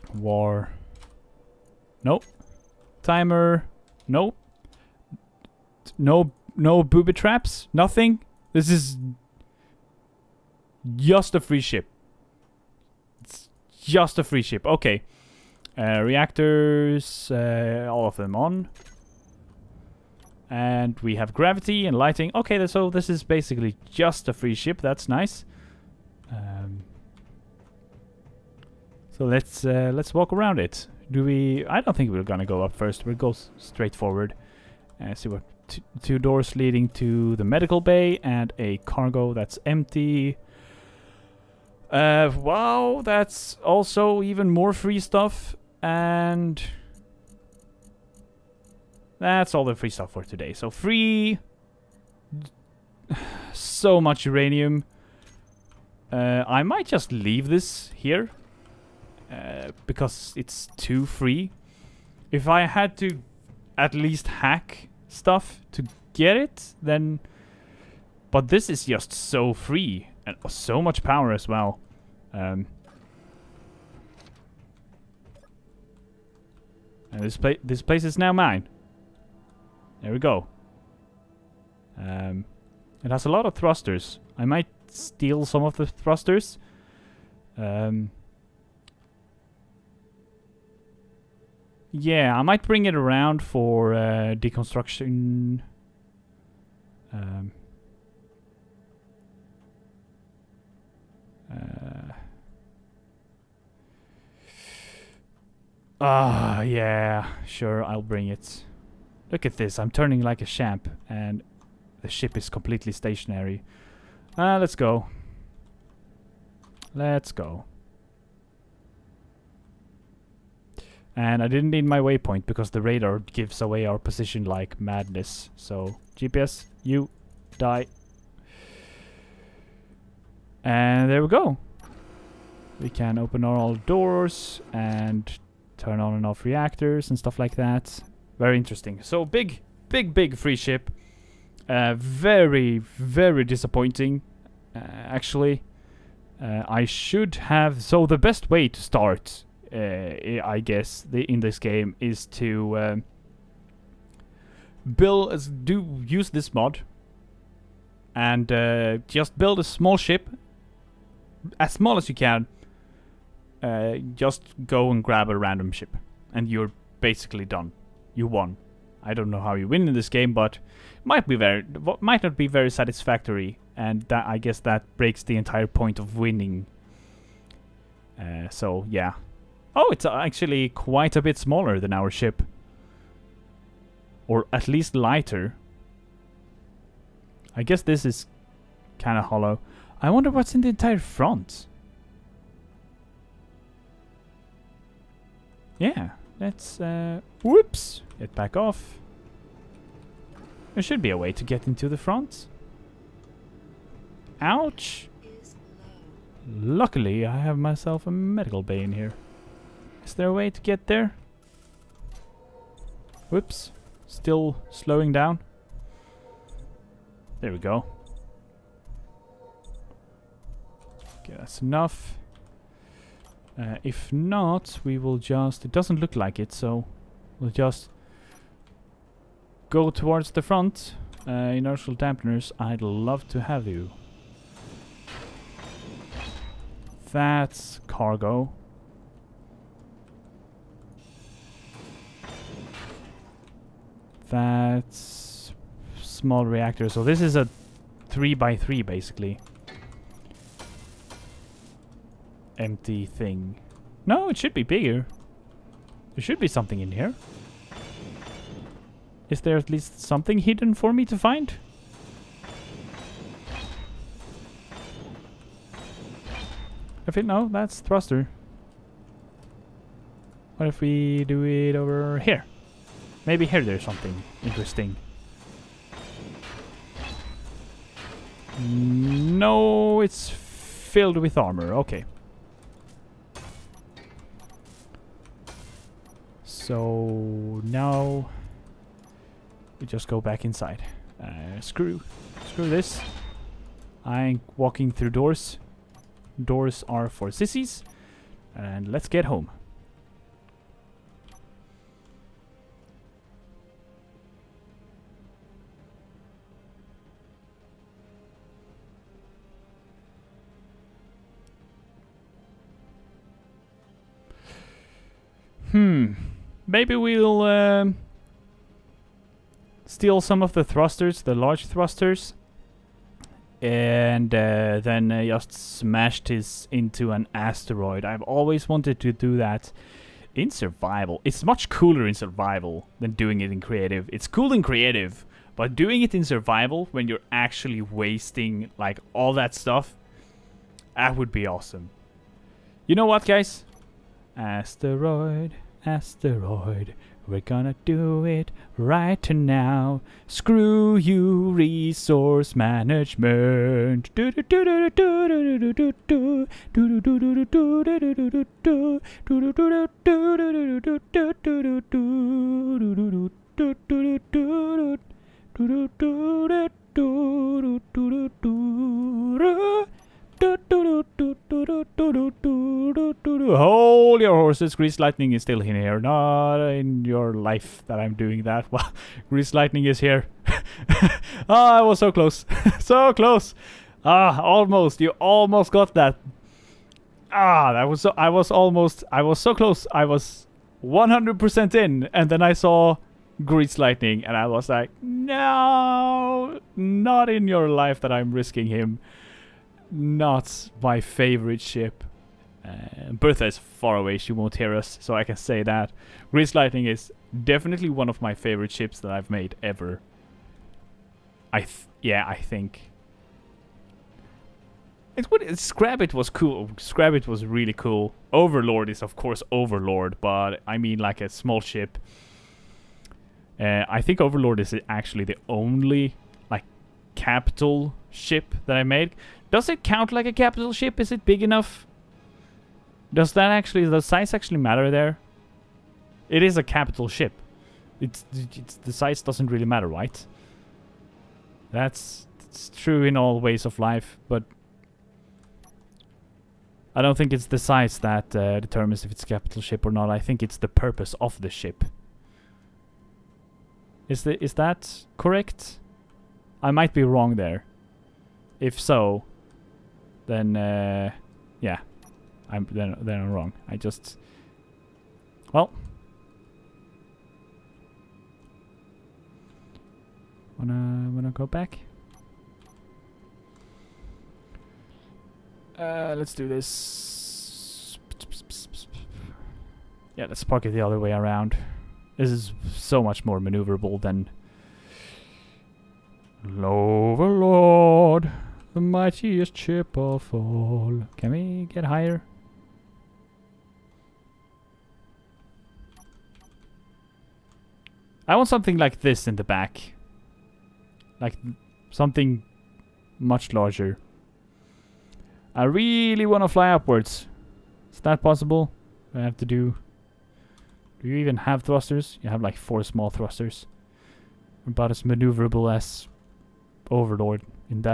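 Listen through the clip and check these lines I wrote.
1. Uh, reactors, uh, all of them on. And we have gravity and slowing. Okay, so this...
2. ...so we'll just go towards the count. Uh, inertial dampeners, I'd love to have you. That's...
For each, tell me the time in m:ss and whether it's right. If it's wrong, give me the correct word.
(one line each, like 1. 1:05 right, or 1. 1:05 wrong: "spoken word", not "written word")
1. 0:15 wrong: "lighting", not "slowing"
2. 3:46 wrong: "front", not "count".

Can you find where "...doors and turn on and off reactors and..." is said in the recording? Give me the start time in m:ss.
2:13.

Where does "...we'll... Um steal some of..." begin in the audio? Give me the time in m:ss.
5:16.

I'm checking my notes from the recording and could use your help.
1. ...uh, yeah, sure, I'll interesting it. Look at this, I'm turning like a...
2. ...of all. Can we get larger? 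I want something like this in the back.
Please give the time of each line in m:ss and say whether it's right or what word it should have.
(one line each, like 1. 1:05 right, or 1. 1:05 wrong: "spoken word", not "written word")
1. 1:46 wrong: "bring", not "interesting"
2. 8:09 wrong: "higher", not "larger".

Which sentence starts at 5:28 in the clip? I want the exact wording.
I've always wanted to do that in survival.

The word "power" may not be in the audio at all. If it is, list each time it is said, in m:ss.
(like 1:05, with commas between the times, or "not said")
1:11.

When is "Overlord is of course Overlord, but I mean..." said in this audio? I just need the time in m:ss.
6:58.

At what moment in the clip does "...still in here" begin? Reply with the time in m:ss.
6:15.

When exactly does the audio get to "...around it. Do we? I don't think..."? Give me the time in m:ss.
0:30.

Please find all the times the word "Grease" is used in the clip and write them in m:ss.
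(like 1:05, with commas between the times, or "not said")
6:14, 6:19, 6:33, 6:46.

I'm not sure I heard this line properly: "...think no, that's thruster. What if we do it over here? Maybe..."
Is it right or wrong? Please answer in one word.
right.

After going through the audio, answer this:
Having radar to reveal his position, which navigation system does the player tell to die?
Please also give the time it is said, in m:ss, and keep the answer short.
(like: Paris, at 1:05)
GPS, at 2:06.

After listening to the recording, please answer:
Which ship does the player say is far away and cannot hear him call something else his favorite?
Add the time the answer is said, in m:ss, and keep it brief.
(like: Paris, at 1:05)
Bertha, at 6:43.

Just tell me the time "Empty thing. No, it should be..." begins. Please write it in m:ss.
4:12.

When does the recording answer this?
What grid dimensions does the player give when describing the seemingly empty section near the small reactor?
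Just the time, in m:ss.
4:08.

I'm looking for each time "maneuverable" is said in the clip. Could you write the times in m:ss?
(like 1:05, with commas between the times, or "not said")
8:03, 8:35.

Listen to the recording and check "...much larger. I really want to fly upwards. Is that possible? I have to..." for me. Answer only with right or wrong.
right.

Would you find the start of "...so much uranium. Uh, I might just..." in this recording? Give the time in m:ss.
0:53.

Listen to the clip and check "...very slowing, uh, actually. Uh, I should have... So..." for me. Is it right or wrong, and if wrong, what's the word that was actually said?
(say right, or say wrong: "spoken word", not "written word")
wrong: "disappointing", not "slowing".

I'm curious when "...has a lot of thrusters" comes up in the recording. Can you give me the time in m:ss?
1:23.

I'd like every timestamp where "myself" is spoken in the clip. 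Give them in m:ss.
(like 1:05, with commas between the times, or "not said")
3:27.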